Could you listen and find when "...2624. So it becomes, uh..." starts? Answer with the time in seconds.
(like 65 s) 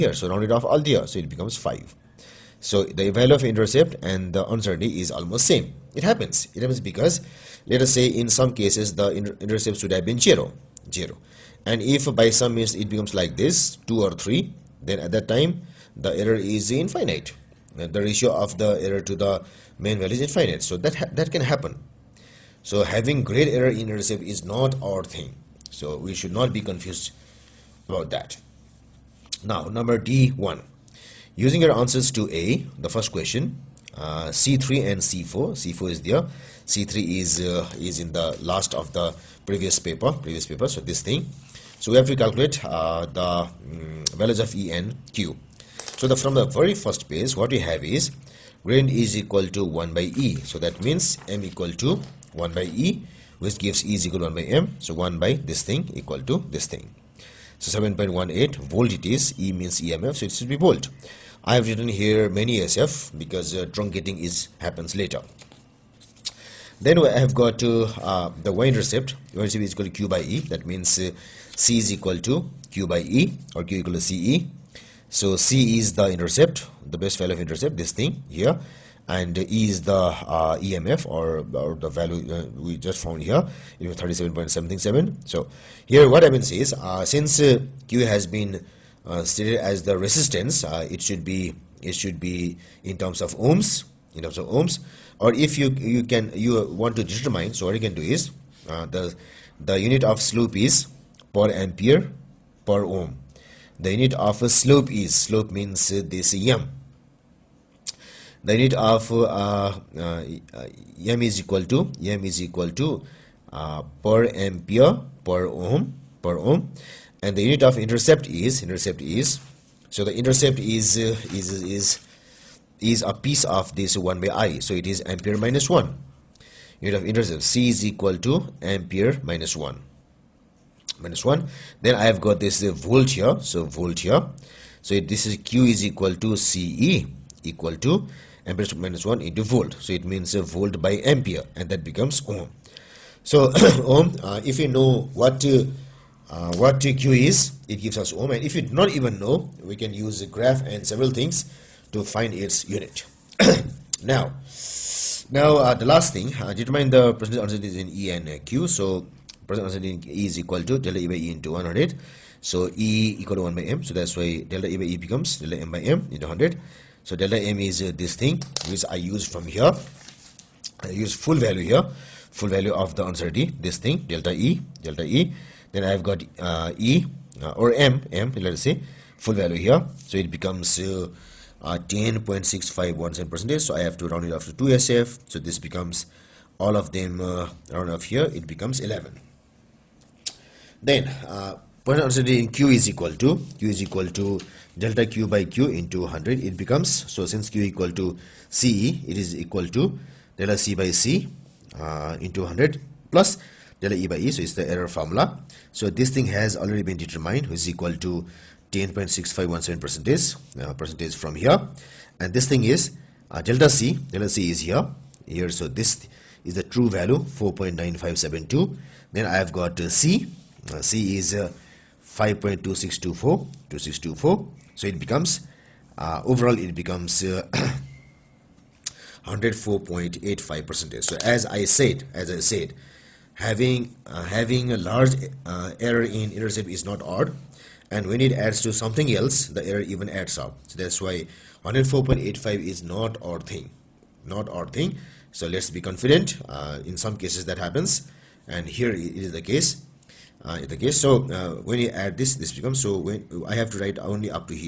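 222 s.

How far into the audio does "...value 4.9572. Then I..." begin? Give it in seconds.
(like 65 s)
216 s.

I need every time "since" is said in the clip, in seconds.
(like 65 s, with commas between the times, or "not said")
87 s, 197 s.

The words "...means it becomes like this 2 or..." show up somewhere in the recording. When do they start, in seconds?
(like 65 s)
12 s.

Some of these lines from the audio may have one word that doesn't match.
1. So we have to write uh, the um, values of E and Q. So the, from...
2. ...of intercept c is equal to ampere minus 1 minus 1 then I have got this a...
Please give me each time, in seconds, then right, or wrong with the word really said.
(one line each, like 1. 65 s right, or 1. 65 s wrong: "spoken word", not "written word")
1. 41 s wrong: "calculate", not "write"
2. 127 s right.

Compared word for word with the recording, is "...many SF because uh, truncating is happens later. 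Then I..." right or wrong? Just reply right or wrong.
right.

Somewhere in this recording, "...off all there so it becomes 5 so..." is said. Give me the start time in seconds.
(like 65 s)
0 s.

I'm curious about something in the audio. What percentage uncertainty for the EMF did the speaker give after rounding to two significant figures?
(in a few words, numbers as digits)
11.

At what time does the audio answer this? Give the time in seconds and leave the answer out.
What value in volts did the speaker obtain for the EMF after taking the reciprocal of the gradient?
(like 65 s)
57 s.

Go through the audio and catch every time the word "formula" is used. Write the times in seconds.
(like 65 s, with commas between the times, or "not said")
204 s.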